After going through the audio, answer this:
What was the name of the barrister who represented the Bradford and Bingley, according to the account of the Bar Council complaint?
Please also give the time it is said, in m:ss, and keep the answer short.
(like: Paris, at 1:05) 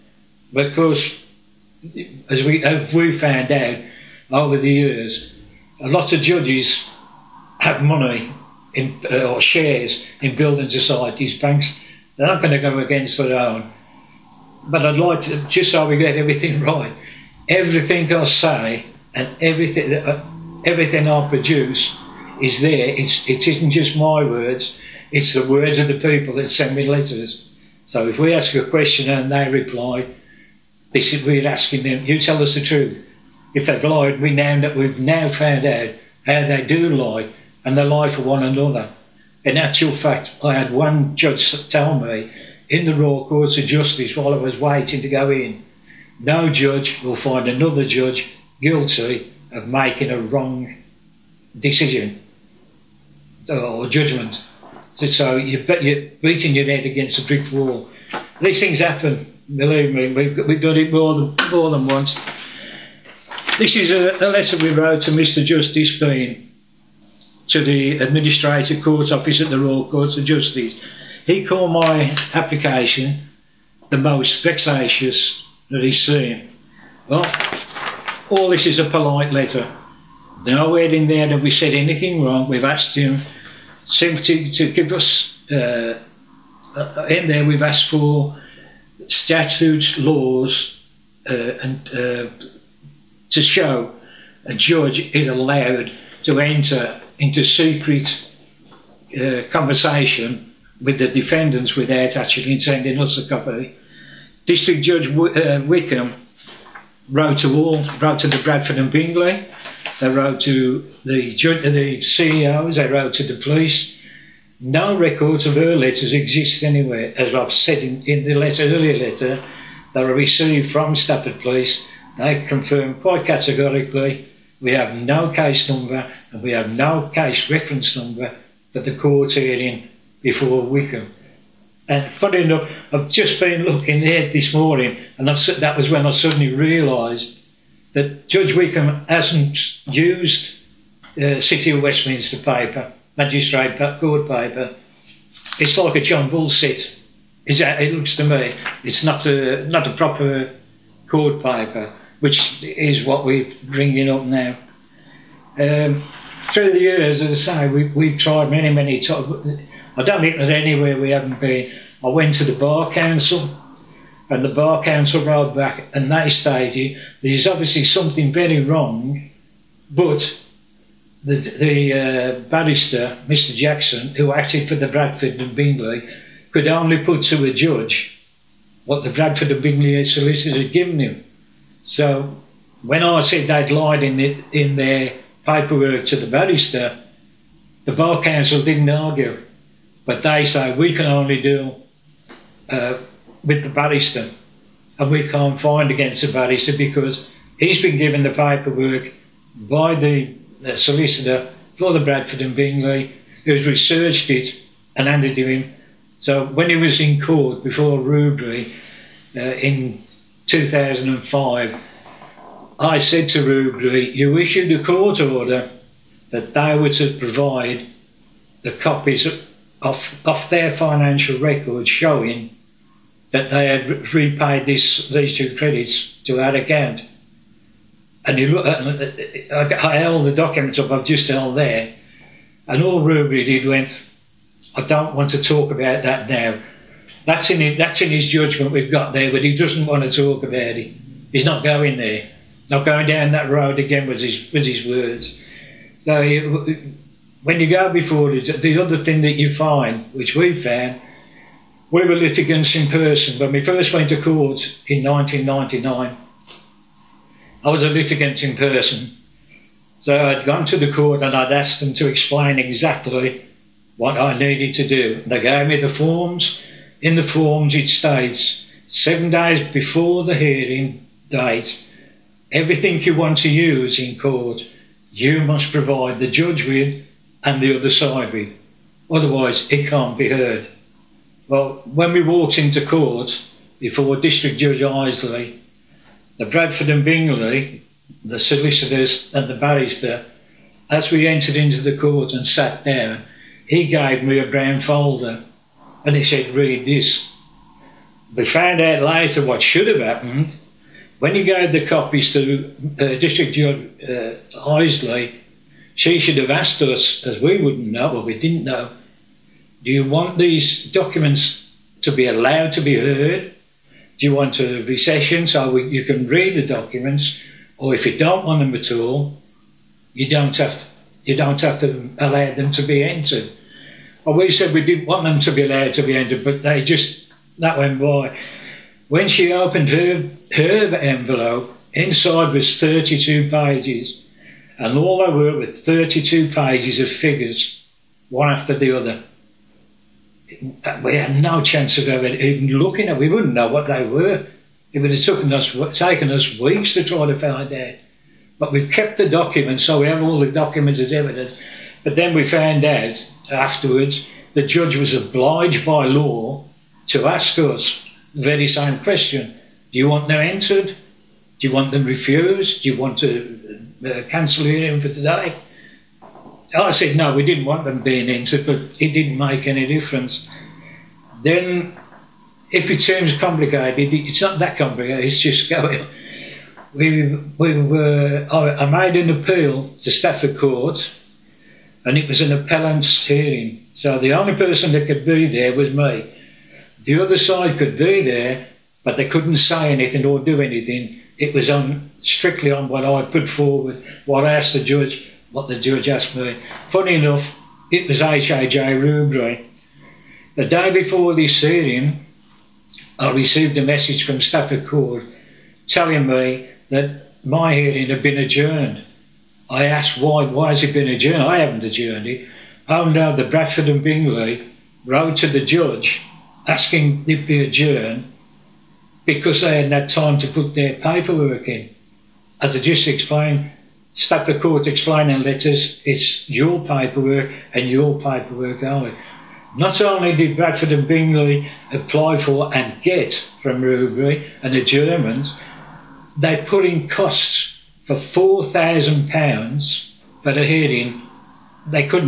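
Mr Jackson, at 2:53.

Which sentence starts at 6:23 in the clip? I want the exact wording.
So the only person that could be there was me.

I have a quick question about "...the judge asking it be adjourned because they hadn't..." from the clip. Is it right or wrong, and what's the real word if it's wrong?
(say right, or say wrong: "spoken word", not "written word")
right.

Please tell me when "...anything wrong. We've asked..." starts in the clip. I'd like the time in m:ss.
1:21.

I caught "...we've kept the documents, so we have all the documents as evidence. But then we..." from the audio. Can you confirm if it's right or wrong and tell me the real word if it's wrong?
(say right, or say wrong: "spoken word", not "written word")
right.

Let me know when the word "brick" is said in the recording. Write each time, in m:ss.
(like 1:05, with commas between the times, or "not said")
0:57.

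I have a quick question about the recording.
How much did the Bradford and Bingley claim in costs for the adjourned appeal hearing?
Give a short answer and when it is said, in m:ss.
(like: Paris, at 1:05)
£4,000, at 7:18.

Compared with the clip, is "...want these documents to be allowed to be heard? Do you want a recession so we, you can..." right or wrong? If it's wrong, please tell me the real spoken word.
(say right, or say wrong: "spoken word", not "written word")
right.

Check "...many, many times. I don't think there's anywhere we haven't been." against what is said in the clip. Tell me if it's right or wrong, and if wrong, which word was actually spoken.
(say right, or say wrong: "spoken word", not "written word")
right.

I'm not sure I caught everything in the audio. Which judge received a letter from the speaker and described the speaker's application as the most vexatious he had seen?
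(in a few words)
Mr Justice Bean.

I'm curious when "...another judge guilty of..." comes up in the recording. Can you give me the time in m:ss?
0:47.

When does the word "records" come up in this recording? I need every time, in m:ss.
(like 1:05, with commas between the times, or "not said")
1:54, 3:41.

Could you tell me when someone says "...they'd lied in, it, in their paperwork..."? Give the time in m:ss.
3:03.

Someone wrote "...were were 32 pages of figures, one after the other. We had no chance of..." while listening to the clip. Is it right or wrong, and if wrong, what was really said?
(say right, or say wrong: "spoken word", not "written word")
right.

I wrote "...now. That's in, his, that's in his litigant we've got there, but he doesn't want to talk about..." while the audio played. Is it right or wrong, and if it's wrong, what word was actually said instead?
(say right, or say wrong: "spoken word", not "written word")
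wrong: "judgment", not "litigant".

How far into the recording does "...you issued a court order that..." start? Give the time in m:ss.
3:34.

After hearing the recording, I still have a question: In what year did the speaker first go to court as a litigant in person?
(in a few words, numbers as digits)
1999.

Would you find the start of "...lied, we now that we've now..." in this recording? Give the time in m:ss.
0:33.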